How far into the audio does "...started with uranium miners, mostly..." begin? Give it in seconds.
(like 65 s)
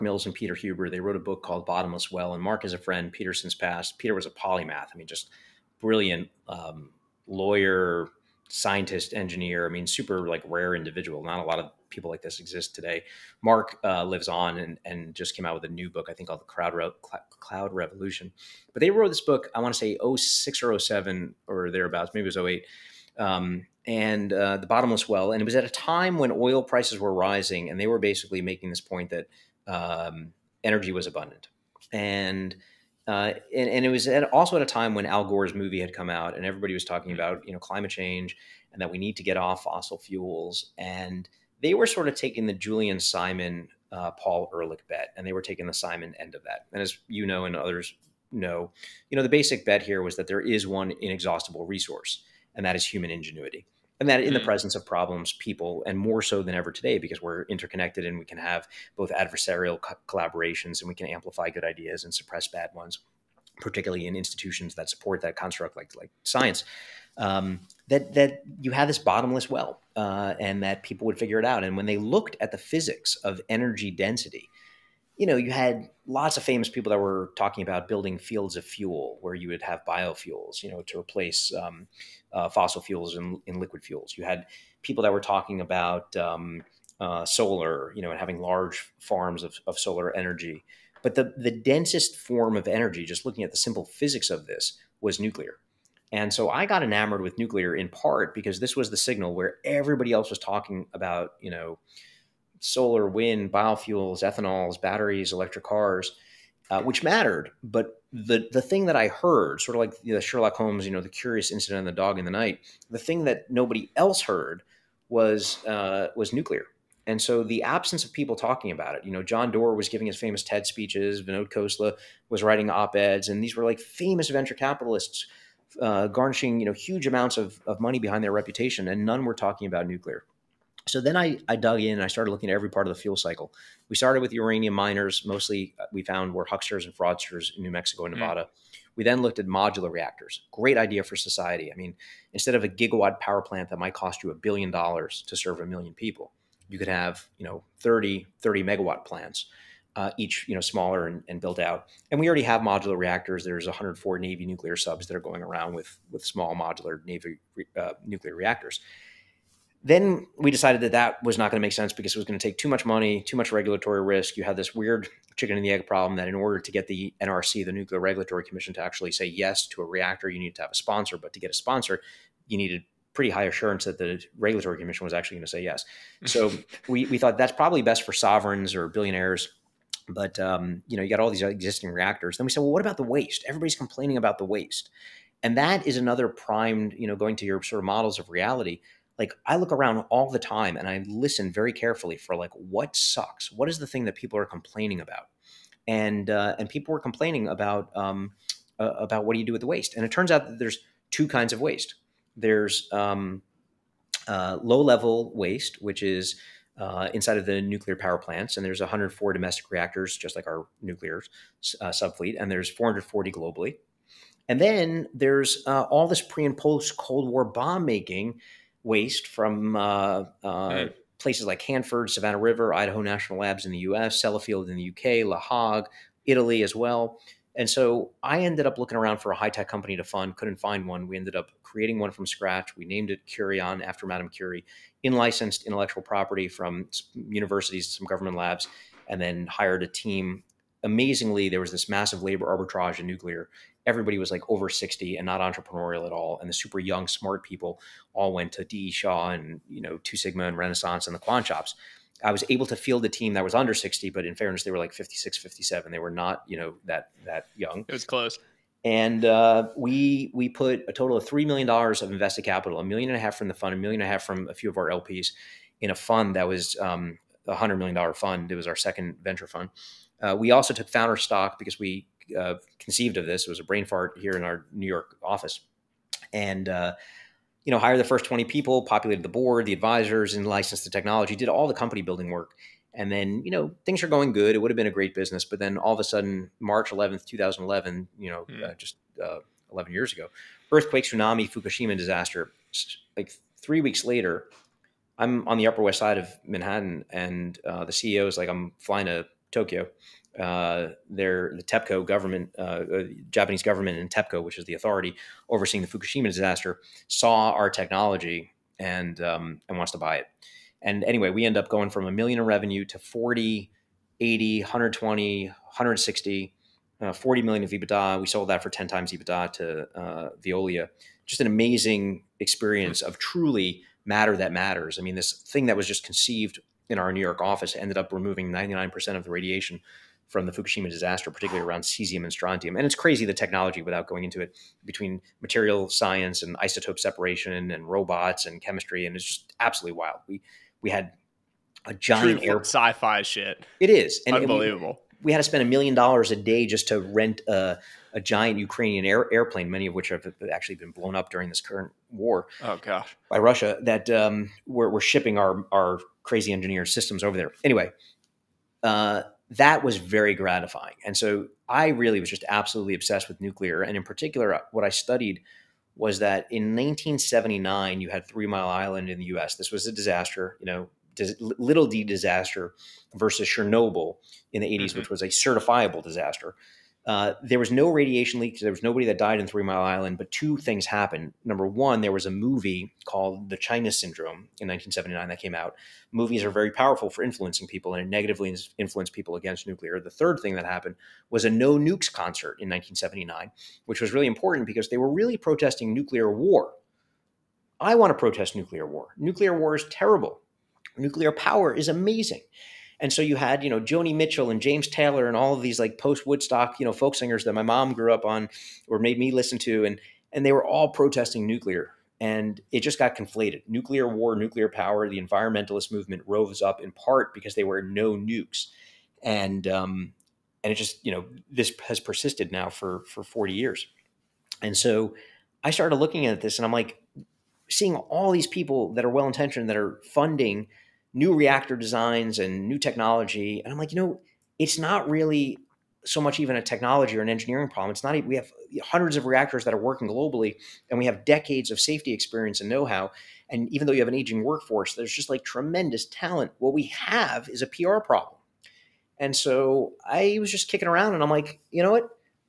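133 s.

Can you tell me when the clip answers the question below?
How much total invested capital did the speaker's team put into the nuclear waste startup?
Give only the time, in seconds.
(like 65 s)
261 s.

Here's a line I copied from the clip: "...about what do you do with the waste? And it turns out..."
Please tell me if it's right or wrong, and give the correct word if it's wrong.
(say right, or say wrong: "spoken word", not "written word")
right.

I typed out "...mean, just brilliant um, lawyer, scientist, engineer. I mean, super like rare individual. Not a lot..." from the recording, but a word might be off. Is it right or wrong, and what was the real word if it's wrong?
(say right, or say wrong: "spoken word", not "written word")
right.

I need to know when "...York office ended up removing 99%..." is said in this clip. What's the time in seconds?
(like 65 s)
327 s.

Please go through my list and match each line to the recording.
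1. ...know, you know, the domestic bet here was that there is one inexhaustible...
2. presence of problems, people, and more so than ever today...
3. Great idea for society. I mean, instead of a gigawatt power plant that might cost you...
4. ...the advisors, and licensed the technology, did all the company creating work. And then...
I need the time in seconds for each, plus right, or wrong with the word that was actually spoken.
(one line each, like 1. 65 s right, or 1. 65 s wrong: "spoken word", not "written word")
1. 48 s wrong: "basic", not "domestic"
2. 54 s right
3. 140 s right
4. 279 s wrong: "building", not "creating".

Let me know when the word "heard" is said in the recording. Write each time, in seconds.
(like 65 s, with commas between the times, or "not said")
109 s, 114 s.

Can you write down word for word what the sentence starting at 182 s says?
Then we said, well, what about the waste?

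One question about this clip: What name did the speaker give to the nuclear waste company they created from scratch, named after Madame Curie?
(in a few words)
Kurion.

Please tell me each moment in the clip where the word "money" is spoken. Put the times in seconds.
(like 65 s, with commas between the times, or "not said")
127 s, 162 s.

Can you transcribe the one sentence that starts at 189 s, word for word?
Like I look around all the time and I listen very carefully for like what sucks.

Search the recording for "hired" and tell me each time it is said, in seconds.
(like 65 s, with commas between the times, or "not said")
239 s, 277 s.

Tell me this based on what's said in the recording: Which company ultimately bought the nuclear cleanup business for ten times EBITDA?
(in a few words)
Veolia.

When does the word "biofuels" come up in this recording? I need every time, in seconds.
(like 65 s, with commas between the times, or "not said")
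79 s, 103 s.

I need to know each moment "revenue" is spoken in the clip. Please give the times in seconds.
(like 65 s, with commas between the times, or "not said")
312 s.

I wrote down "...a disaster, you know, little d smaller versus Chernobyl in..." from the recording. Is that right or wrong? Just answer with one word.
wrong.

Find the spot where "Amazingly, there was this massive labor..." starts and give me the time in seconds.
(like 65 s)
240 s.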